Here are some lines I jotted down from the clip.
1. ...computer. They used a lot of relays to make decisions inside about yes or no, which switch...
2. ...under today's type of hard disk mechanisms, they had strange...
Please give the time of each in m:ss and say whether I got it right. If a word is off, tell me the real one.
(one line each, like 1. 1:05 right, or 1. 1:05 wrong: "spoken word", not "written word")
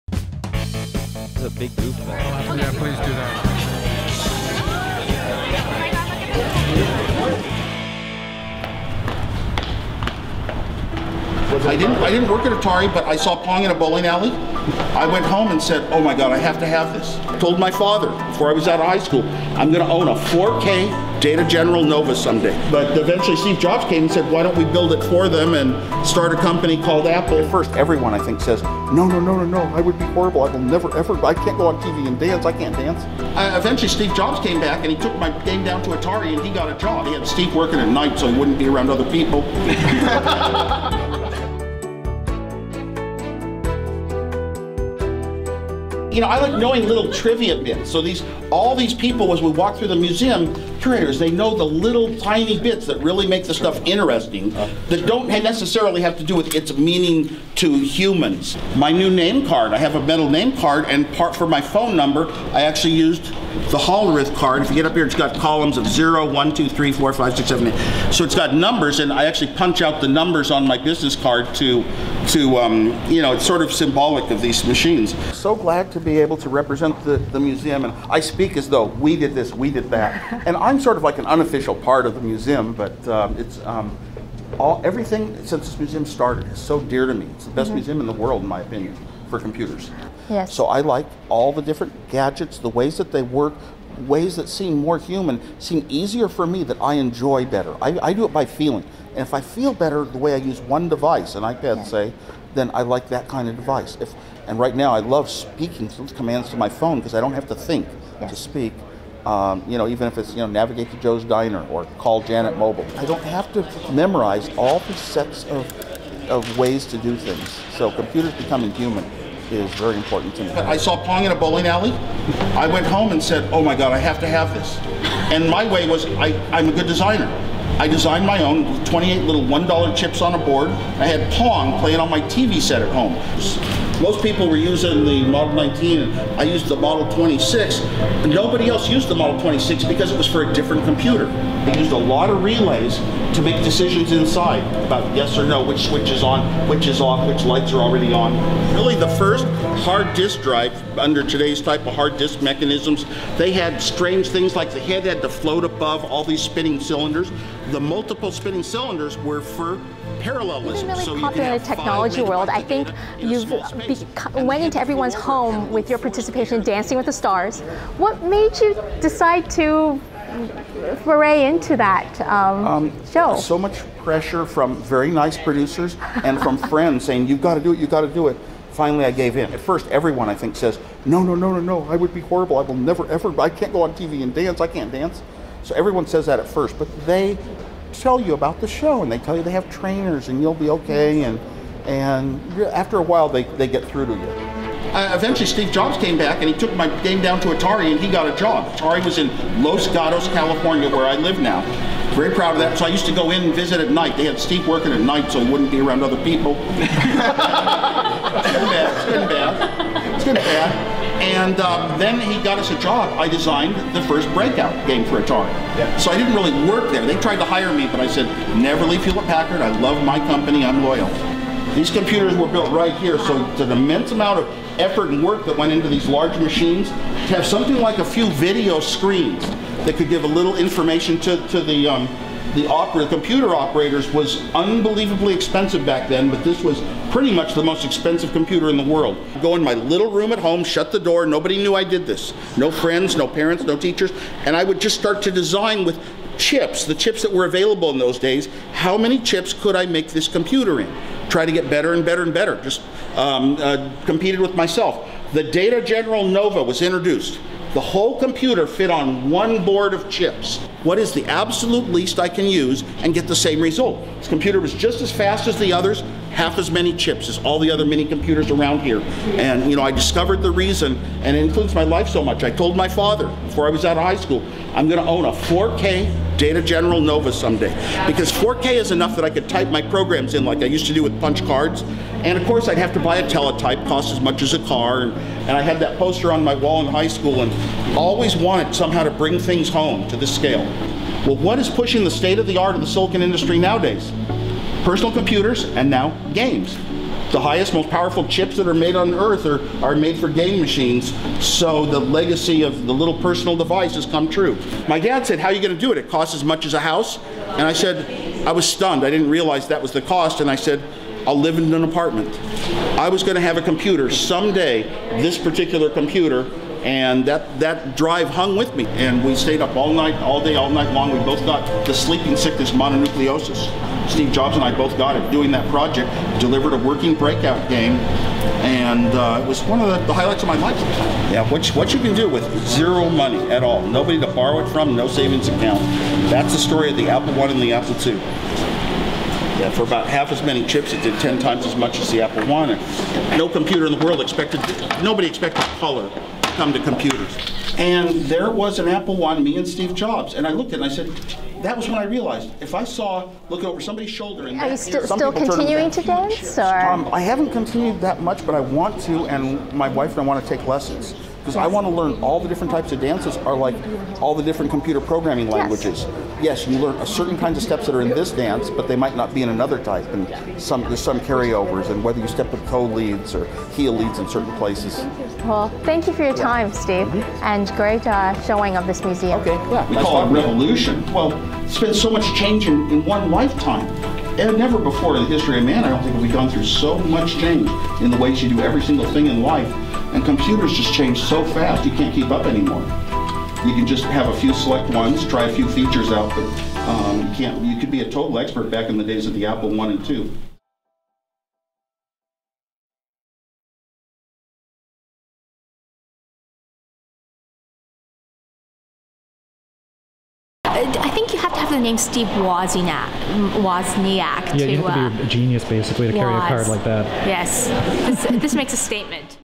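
1. 2:20 right
2. 2:30 right.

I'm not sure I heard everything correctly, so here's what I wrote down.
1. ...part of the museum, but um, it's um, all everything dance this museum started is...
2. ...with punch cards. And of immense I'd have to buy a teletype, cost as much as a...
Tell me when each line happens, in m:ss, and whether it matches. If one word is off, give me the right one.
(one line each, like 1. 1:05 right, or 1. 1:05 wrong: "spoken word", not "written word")
1. 1:21 wrong: "since", not "dance"
2. 4:41 wrong: "course", not "immense".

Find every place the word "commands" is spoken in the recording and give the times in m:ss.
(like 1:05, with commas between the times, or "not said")
1:46.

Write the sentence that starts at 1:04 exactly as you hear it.
If you get up here, it's got columns of 0, 1, 2, 3, 4, 5, 6, 7, 8.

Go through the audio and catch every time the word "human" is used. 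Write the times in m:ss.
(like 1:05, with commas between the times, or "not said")
0:57, 1:35, 1:58.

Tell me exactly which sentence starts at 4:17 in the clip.
The whole computer fit on one board of chips.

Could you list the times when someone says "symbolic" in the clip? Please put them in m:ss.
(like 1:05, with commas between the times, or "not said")
1:13.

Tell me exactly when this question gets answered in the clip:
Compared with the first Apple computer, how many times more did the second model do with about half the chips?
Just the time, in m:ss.
5:41.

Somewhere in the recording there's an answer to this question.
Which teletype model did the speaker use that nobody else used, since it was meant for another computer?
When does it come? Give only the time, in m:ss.
2:16.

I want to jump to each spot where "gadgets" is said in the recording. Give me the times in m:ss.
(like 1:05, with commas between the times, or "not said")
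1:32.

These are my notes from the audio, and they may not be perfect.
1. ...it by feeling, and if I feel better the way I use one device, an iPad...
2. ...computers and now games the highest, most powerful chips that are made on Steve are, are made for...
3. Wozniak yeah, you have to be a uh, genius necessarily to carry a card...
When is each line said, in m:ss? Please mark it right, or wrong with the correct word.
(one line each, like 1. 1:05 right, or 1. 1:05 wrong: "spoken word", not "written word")
1. 1:38 right
2. 4:55 wrong: "Earth", not "Steve"
3. 6:53 wrong: "basically", not "necessarily".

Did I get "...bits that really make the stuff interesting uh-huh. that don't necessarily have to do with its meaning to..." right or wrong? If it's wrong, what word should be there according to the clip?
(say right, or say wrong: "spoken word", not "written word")
right.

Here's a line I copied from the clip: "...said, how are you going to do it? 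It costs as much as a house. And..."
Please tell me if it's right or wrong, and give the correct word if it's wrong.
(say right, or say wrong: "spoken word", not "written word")
right.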